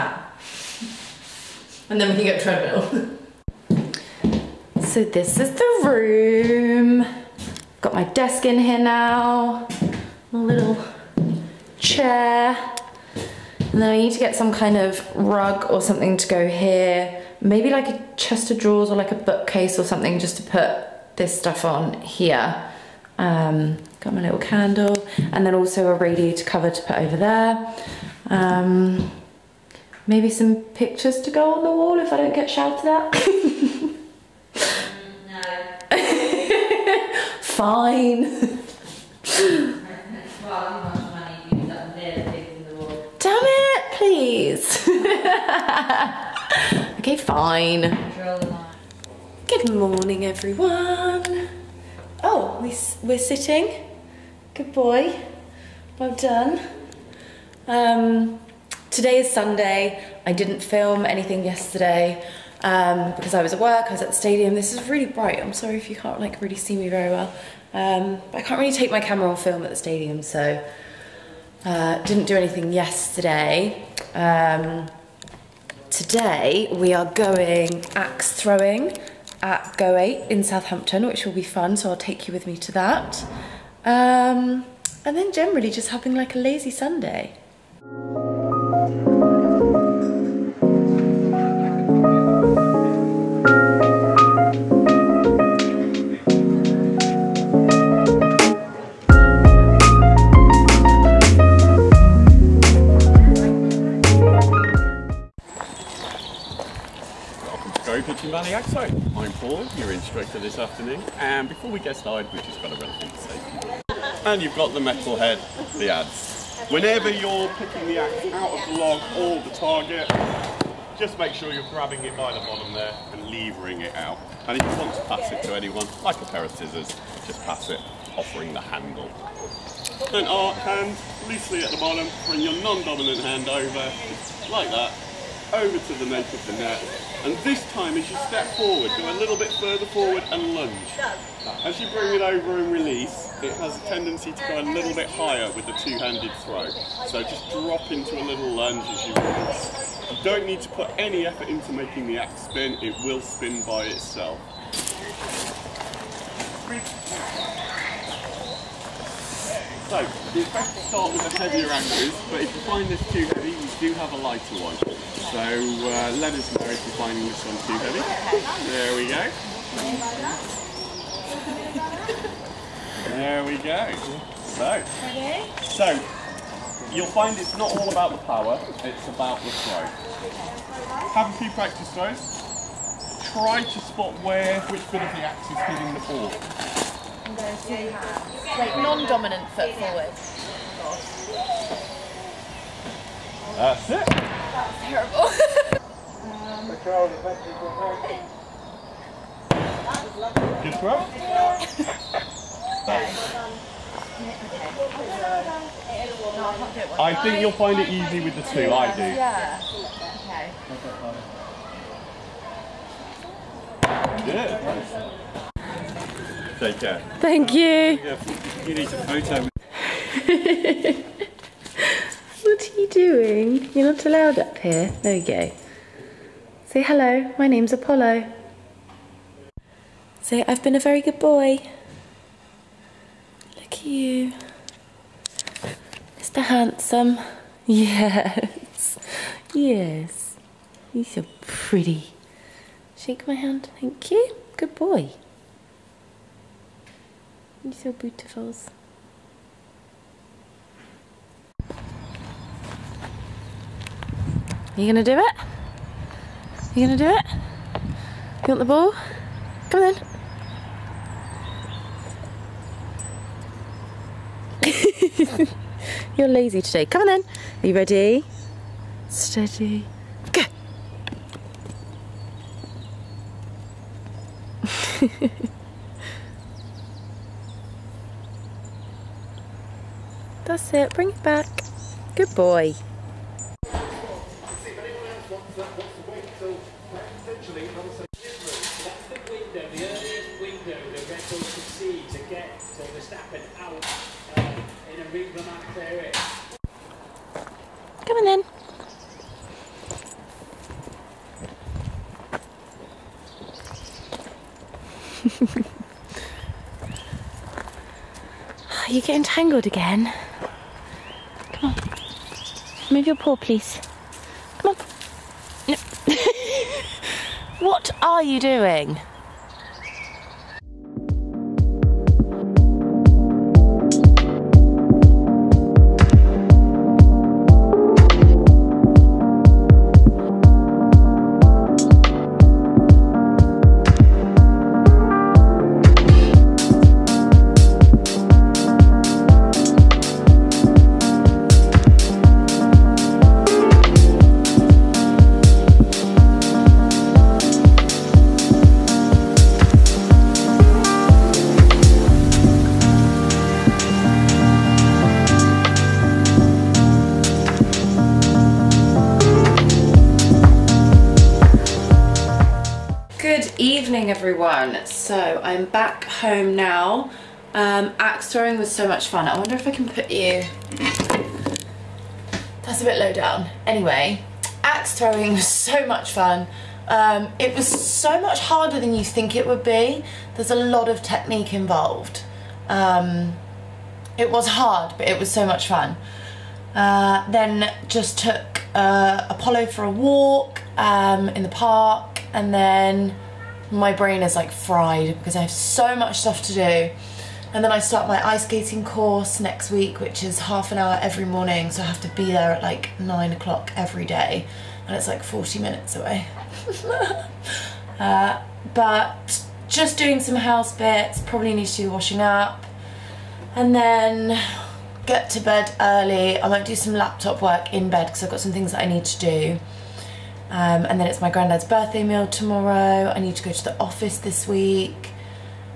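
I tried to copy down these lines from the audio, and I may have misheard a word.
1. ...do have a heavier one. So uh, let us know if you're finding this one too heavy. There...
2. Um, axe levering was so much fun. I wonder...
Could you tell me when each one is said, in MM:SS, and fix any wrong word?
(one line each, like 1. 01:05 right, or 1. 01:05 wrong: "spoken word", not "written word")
1. 02:43 wrong: "lighter", not "heavier"
2. 06:07 wrong: "throwing", not "levering".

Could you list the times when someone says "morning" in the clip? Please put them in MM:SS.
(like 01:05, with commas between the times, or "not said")
00:49, 06:41.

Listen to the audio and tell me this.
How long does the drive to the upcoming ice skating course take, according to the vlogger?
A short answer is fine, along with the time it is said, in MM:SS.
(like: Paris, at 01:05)
40 minutes, at 06:45.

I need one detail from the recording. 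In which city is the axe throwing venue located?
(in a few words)
Southampton.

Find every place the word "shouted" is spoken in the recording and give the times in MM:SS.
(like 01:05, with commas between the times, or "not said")
00:32.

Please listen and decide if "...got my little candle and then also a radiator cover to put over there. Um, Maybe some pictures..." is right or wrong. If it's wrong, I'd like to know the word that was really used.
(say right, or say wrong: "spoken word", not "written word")
right.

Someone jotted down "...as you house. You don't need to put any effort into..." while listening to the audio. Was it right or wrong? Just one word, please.
wrong.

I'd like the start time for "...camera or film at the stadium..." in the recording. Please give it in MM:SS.
01:09.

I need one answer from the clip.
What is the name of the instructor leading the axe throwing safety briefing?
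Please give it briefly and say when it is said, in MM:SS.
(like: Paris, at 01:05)
Paul, at 01:49.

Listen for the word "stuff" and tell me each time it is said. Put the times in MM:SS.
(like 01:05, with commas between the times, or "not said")
00:21, 06:36.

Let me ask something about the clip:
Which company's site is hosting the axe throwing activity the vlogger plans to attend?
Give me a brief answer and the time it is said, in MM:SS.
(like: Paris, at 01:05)
Go Ape, at 01:19.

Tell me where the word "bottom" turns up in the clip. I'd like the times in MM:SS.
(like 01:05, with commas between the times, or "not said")
02:02, 02:11.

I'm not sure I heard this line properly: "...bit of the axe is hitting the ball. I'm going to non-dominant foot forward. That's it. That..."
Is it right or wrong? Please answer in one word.
right.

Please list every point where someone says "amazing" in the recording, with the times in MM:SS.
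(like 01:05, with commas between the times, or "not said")
not said.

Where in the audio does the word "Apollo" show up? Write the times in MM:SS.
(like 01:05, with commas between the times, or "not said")
03:47, 06:29.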